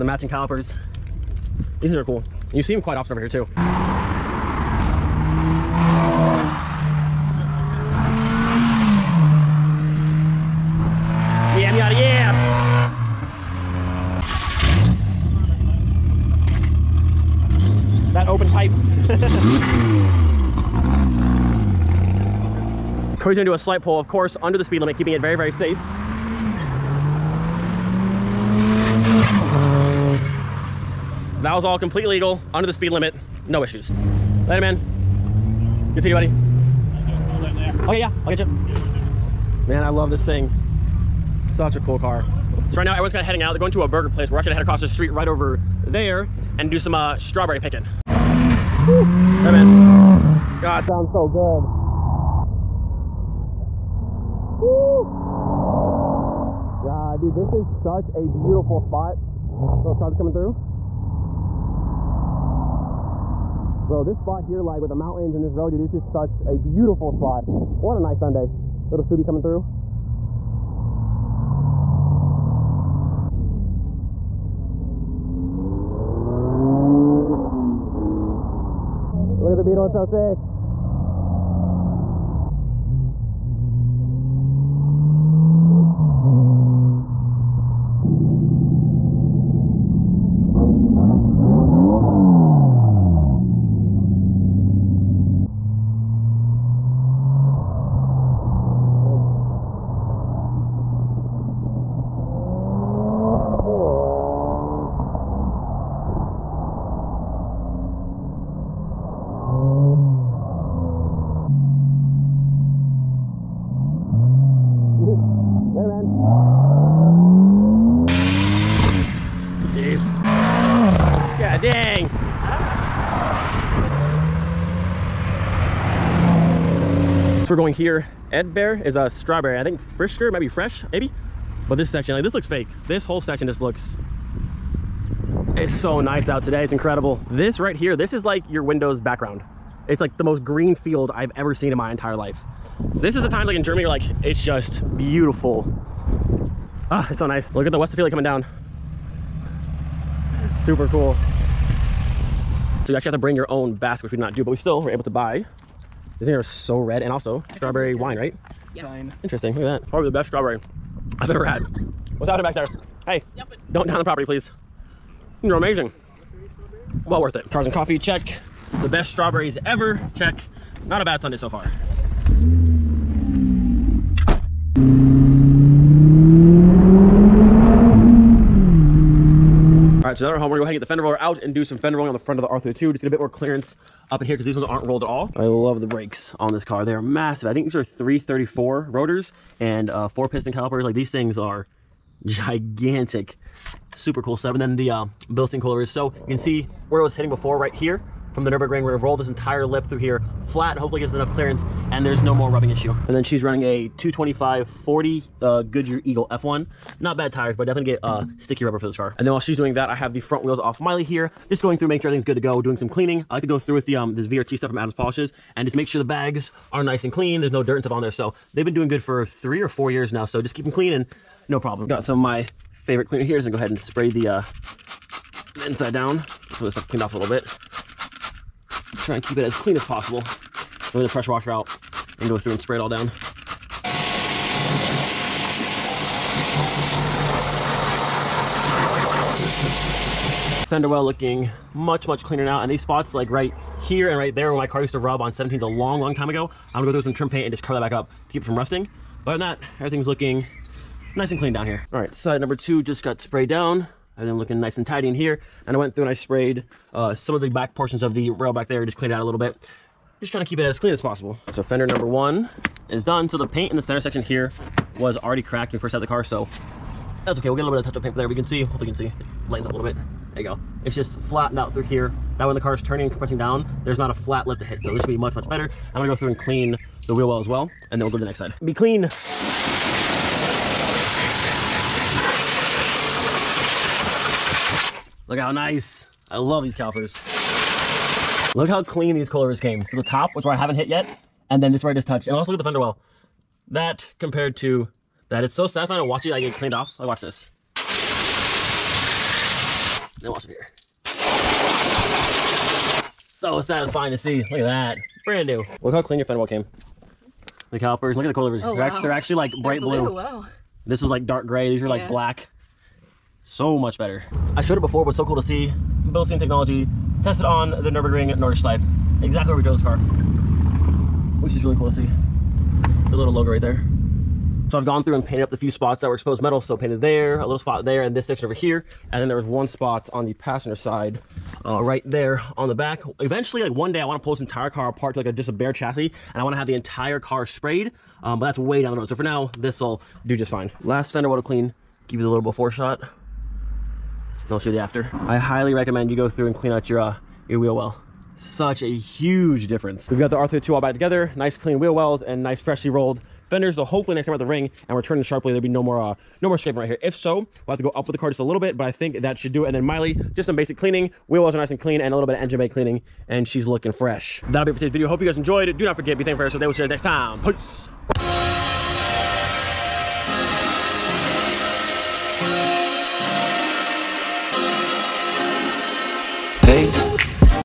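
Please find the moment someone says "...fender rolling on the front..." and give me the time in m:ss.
3:01.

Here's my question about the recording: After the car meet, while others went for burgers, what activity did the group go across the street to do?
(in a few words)
Strawberry picking.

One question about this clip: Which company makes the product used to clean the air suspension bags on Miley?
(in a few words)
Adams Polishes.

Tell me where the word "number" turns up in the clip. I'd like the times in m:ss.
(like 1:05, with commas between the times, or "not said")
4:12, 4:21.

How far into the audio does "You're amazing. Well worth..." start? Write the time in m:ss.
2:45.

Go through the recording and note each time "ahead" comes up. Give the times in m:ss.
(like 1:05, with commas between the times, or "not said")
3:00, 3:43.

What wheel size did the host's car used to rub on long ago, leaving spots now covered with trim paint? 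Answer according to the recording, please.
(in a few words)
17s.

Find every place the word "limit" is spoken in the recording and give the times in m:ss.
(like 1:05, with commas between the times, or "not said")
0:24, 0:32.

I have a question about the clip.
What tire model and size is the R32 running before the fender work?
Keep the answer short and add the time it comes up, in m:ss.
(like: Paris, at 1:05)
225-40 Goodyear Eagle F1, at 3:23.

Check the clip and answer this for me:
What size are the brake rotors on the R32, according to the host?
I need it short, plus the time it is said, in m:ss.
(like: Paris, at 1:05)
334, at 3:07.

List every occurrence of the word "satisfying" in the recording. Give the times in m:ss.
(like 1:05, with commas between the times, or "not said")
4:55, 5:03.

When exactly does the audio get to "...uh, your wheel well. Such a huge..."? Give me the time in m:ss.
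5:46.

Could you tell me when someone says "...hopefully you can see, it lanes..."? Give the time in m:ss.
4:28.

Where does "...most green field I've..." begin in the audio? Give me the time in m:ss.
2:20.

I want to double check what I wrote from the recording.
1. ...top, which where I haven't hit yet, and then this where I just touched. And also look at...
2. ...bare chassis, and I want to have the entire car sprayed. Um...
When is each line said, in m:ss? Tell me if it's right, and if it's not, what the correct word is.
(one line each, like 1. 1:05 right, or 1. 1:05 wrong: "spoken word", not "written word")
1. 4:50 right
2. 5:35 right.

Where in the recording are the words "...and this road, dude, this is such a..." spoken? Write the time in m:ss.
1:05.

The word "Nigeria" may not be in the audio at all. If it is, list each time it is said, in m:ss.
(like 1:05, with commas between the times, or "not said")
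not said.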